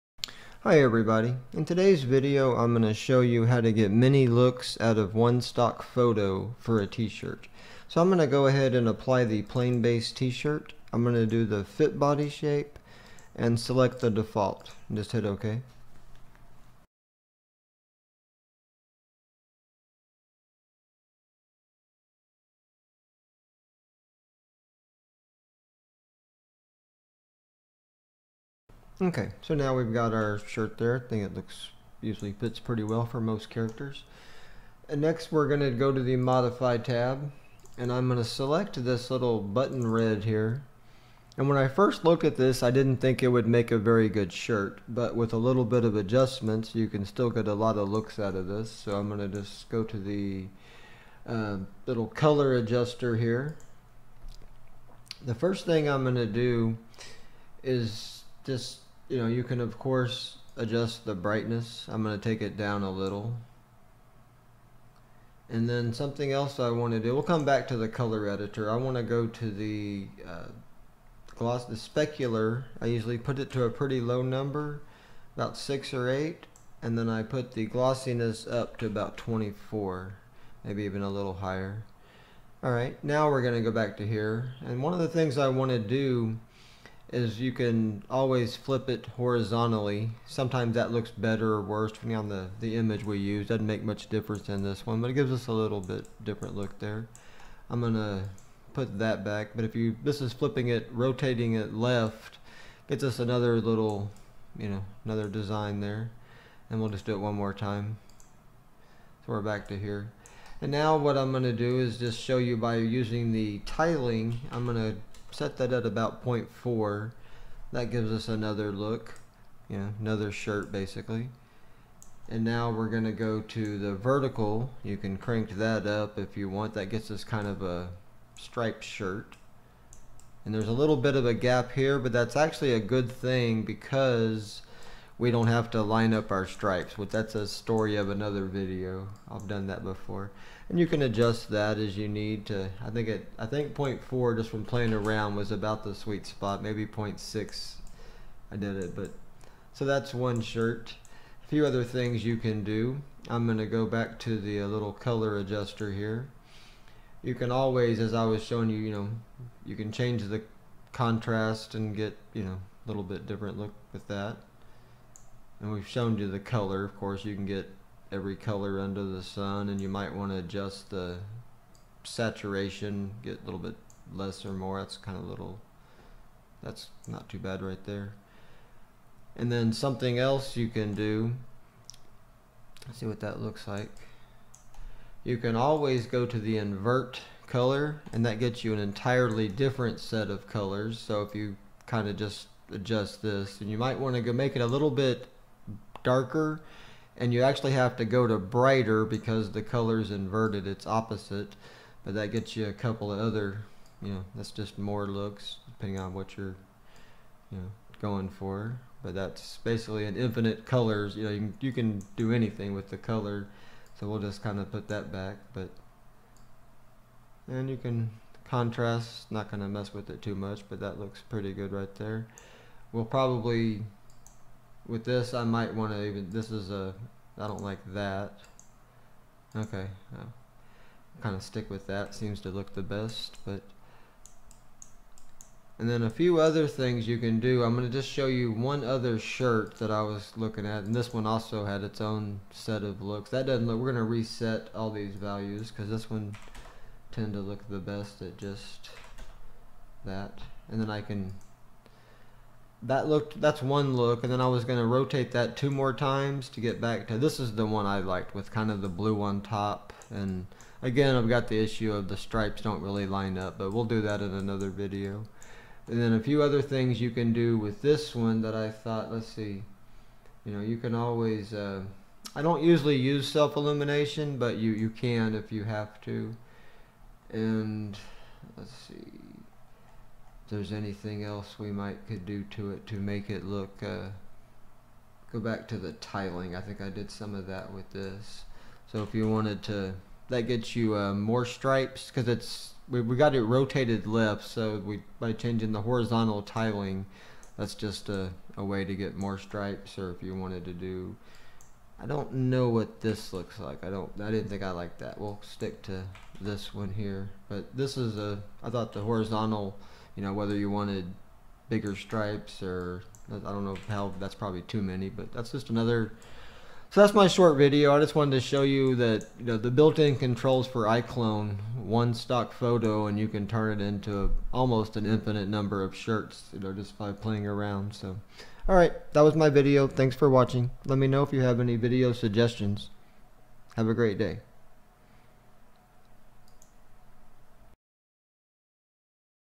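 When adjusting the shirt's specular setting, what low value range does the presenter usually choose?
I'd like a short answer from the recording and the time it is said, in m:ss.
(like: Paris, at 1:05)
6 or 8, at 1:15.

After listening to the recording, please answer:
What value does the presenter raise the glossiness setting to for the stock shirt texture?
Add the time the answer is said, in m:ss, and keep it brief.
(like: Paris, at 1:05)
24, at 1:18.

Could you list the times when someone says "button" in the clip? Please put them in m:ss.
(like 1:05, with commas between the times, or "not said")
0:39.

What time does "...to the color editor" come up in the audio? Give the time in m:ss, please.
1:07.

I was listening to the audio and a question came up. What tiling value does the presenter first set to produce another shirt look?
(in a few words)
0.4.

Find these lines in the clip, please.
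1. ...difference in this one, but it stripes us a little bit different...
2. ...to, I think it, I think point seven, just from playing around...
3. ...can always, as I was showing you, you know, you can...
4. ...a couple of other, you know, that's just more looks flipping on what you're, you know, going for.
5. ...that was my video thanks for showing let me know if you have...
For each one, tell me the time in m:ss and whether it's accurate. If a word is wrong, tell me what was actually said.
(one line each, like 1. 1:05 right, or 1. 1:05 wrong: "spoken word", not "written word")
1. 1:34 wrong: "gives", not "stripes"
2. 2:22 wrong: "four", not "seven"
3. 2:37 right
4. 3:22 wrong: "depending", not "flipping"
5. 5:29 wrong: "watching", not "showing".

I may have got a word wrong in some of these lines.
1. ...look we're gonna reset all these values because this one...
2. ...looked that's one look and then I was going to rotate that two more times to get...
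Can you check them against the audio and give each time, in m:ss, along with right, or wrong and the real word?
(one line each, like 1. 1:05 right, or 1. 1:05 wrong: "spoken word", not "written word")
1. 4:03 right
2. 4:13 right.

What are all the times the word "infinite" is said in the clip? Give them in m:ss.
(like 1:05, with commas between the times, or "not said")
3:30, 5:25.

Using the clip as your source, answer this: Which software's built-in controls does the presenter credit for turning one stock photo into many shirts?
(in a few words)
iClone.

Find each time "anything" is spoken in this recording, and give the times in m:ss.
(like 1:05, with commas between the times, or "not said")
3:32, 4:40.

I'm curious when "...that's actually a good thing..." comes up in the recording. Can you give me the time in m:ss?
2:12.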